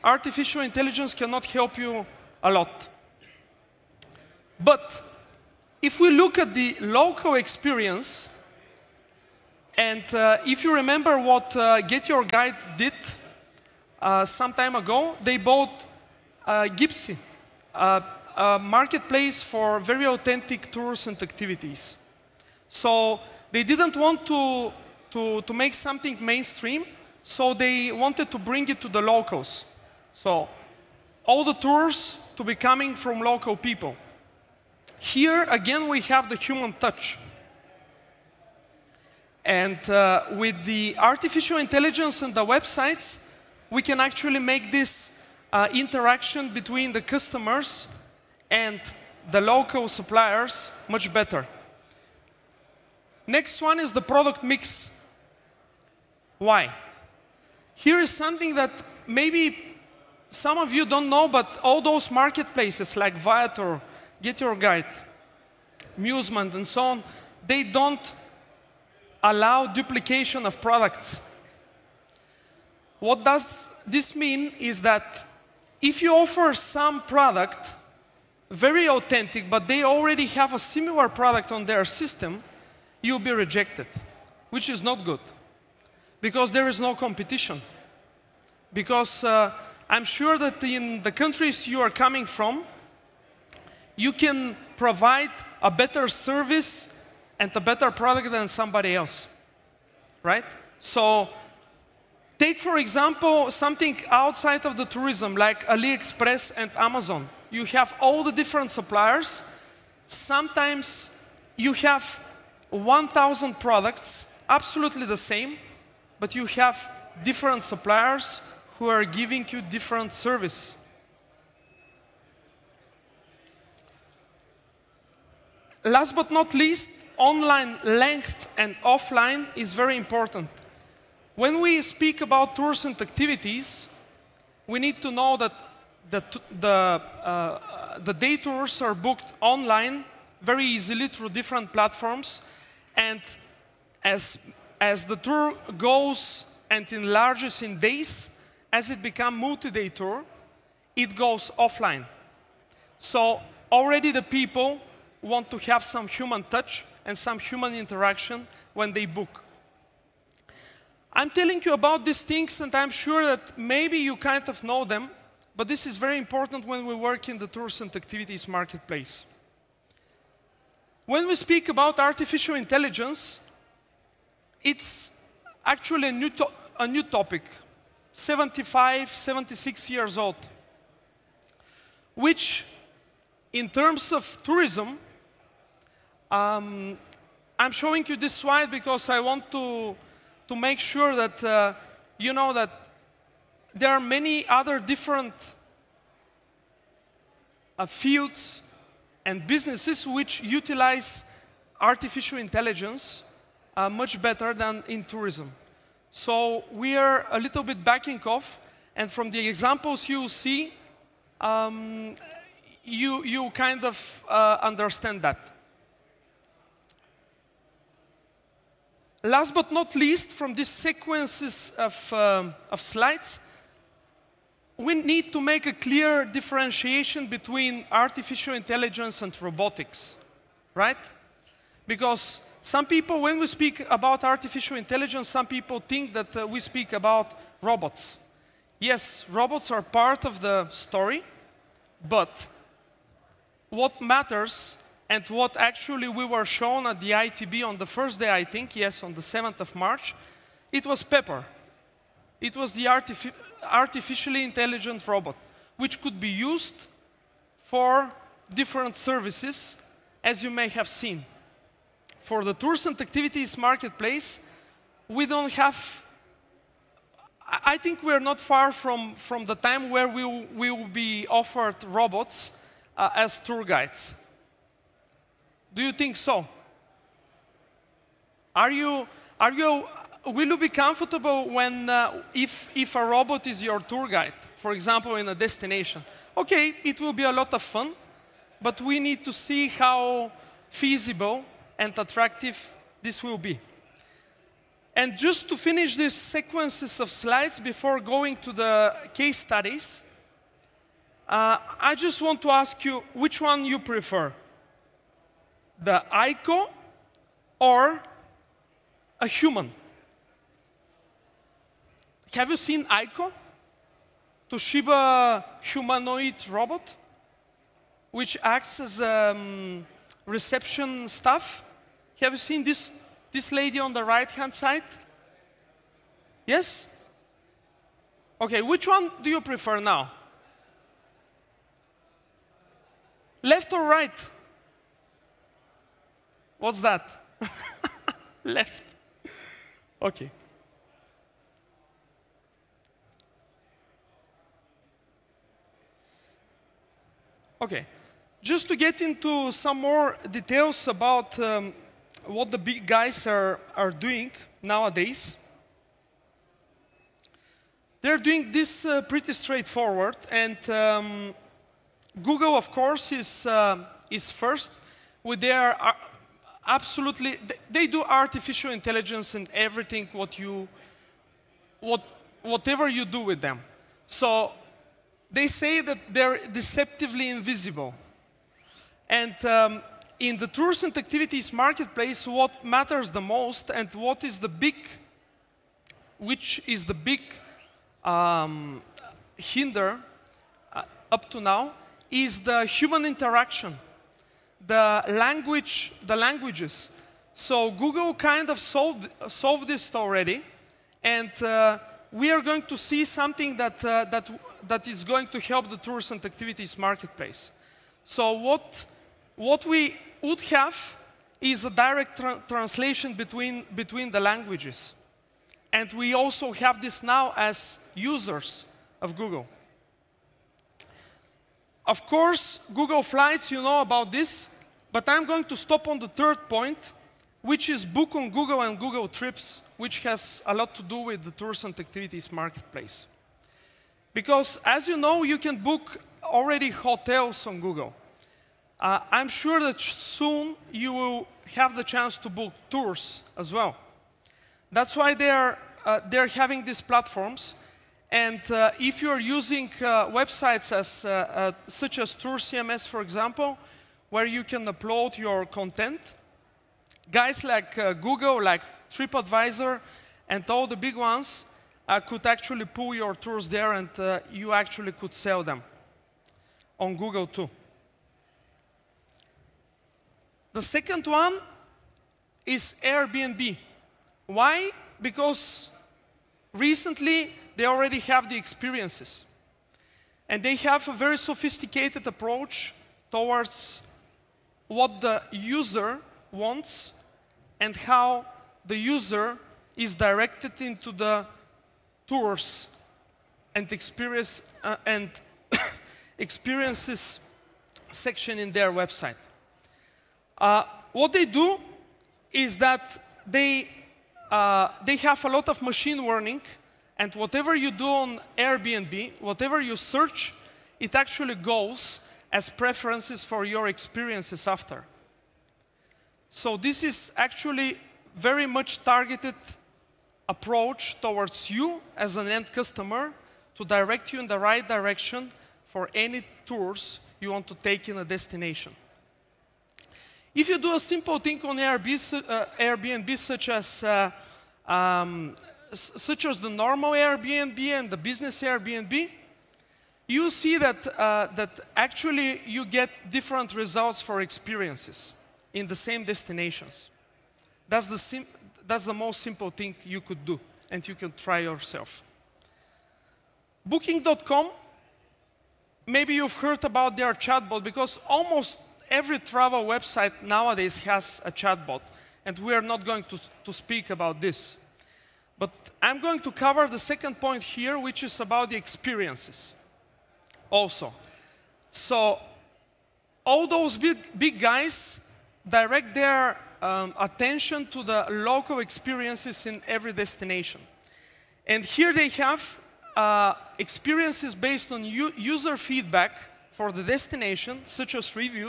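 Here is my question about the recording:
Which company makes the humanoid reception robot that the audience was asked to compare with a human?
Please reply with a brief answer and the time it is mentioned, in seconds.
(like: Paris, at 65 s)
Toshiba, at 314 s.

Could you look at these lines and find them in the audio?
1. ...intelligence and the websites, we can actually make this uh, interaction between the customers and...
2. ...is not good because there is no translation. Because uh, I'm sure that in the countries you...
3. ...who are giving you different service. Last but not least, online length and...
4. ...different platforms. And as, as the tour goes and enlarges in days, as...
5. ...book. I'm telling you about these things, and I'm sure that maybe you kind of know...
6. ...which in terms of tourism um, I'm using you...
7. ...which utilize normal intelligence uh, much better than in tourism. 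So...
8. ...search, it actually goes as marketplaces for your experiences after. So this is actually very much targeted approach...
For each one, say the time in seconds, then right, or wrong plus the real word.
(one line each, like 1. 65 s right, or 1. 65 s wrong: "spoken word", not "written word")
1. 41 s right
2. 84 s wrong: "competition", not "translation"
3. 118 s right
4. 141 s right
5. 159 s right
6. 182 s wrong: "showing", not "using"
7. 200 s wrong: "artificial", not "normal"
8. 509 s wrong: "preferences", not "marketplaces".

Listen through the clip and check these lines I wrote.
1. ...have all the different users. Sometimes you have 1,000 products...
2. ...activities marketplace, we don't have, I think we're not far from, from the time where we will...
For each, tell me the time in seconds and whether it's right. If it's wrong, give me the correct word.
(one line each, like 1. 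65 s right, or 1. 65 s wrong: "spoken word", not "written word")
1. 107 s wrong: "suppliers", not "users"
2. 263 s right.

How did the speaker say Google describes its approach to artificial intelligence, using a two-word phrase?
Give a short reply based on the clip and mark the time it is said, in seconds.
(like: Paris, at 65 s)
deceptively invisible, at 376 s.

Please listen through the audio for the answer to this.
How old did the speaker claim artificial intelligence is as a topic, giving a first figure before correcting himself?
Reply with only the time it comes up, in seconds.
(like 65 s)
178 s.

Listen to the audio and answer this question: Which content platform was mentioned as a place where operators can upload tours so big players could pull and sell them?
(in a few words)
Tour CMS.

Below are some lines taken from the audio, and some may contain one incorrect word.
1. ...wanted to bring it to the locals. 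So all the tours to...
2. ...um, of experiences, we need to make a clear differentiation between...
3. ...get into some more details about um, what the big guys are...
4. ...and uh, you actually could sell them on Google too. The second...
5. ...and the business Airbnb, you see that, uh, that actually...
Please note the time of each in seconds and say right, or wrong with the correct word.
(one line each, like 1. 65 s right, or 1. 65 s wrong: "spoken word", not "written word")
1. 27 s right
2. 222 s wrong: "slides", not "experiences"
3. 348 s right
4. 463 s right
5. 537 s right.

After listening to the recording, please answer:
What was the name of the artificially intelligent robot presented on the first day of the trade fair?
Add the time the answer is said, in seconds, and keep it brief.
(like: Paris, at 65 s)
Pepper, at 251 s.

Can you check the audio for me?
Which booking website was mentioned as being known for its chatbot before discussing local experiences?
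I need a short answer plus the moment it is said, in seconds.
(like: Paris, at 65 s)
Booking.com, at 553 s.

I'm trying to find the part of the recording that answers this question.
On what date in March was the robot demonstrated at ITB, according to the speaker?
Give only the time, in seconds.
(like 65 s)
249 s.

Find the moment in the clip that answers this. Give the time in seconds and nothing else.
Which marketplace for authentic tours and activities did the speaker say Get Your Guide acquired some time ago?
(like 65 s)
16 s.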